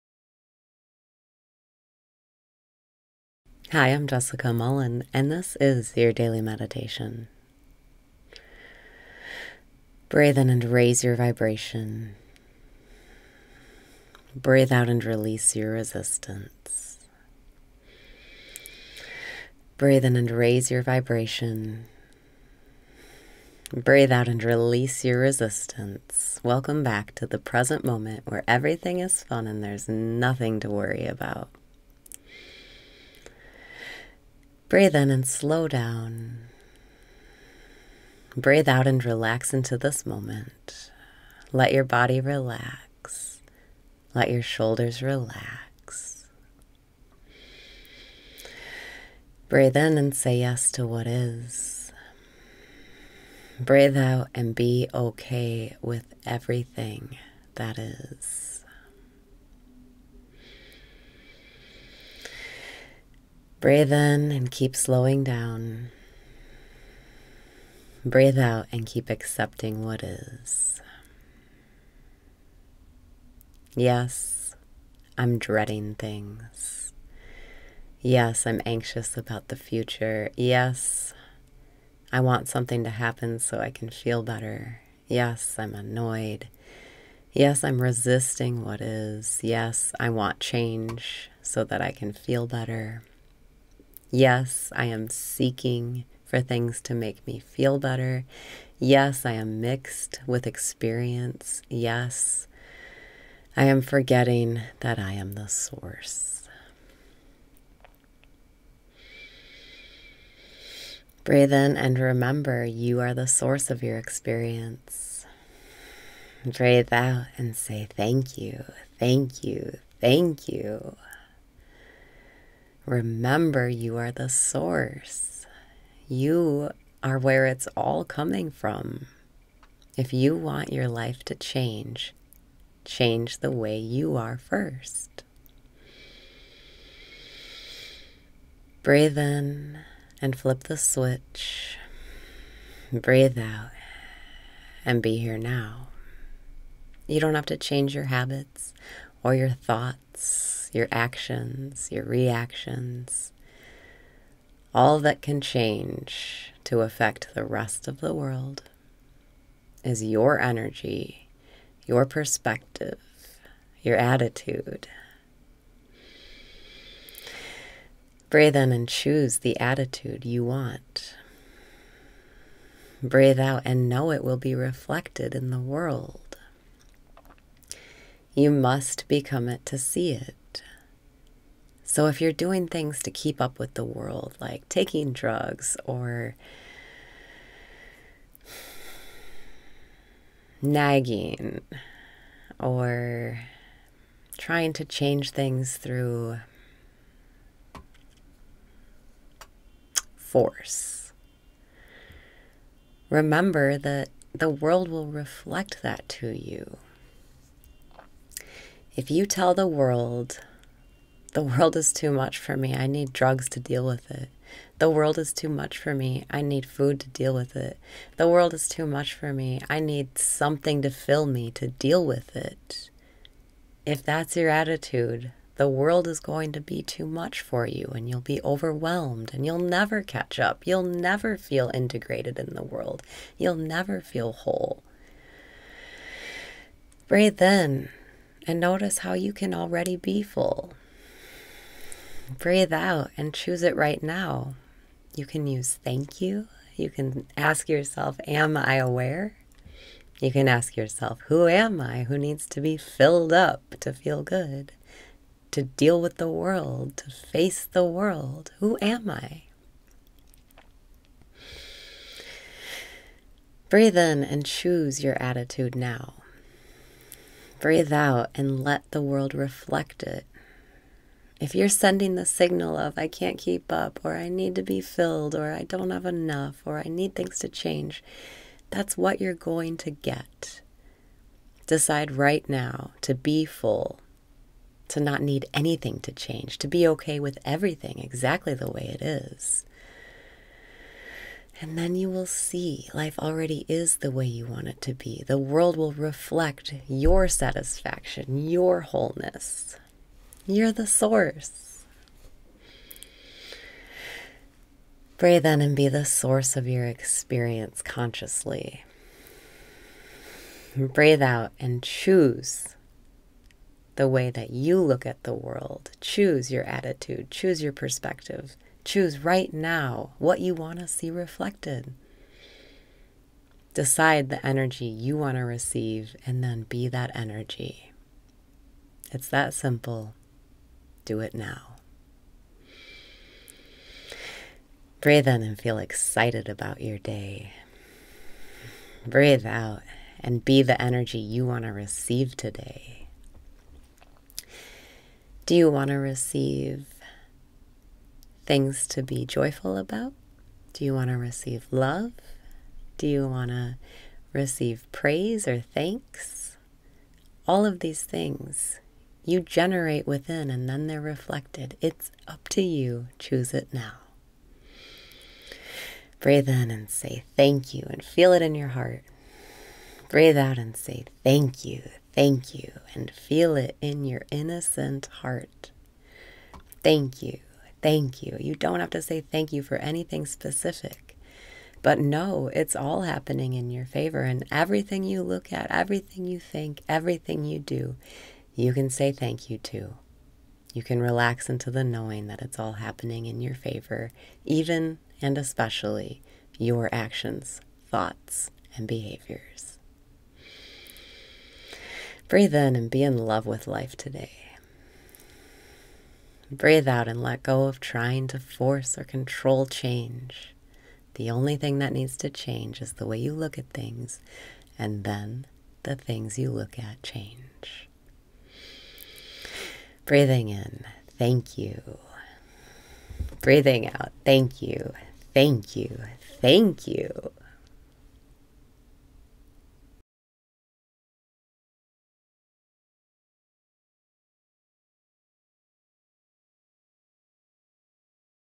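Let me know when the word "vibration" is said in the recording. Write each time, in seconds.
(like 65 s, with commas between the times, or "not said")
11 s, 20 s.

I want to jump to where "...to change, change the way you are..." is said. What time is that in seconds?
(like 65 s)
131 s.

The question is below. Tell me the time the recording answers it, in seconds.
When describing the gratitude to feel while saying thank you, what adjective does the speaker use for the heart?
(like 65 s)
374 s.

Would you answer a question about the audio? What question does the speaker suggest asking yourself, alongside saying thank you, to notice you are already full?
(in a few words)
Am I aware?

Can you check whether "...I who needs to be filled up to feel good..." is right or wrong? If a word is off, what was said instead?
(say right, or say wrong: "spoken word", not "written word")
right.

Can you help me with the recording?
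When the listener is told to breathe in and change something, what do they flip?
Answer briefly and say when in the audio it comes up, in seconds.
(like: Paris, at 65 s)
the switch, at 140 s.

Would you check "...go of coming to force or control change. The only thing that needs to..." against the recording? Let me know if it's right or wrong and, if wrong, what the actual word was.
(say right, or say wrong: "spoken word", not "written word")
wrong: "trying", not "coming".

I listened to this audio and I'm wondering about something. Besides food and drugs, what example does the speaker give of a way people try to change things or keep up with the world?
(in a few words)
nagging.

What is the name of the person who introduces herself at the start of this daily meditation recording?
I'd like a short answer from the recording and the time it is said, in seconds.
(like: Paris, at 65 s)
Jessica Mullen, at 4 s.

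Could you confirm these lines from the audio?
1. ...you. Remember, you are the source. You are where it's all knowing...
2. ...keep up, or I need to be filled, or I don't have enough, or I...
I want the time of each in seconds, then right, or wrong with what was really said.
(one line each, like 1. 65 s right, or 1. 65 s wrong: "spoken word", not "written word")
1. 120 s wrong: "coming", not "knowing"
2. 273 s right.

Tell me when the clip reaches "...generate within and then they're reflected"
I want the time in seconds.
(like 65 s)
359 s.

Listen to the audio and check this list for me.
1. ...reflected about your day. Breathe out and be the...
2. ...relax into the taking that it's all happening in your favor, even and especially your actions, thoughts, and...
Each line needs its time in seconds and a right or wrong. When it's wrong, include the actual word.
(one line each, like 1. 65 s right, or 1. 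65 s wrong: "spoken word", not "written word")
1. 335 s wrong: "excited", not "reflected"
2. 391 s wrong: "knowing", not "taking".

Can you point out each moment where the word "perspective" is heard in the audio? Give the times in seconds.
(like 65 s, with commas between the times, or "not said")
162 s, 317 s.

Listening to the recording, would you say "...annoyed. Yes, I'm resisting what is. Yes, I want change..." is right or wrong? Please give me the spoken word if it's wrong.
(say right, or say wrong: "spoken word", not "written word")
right.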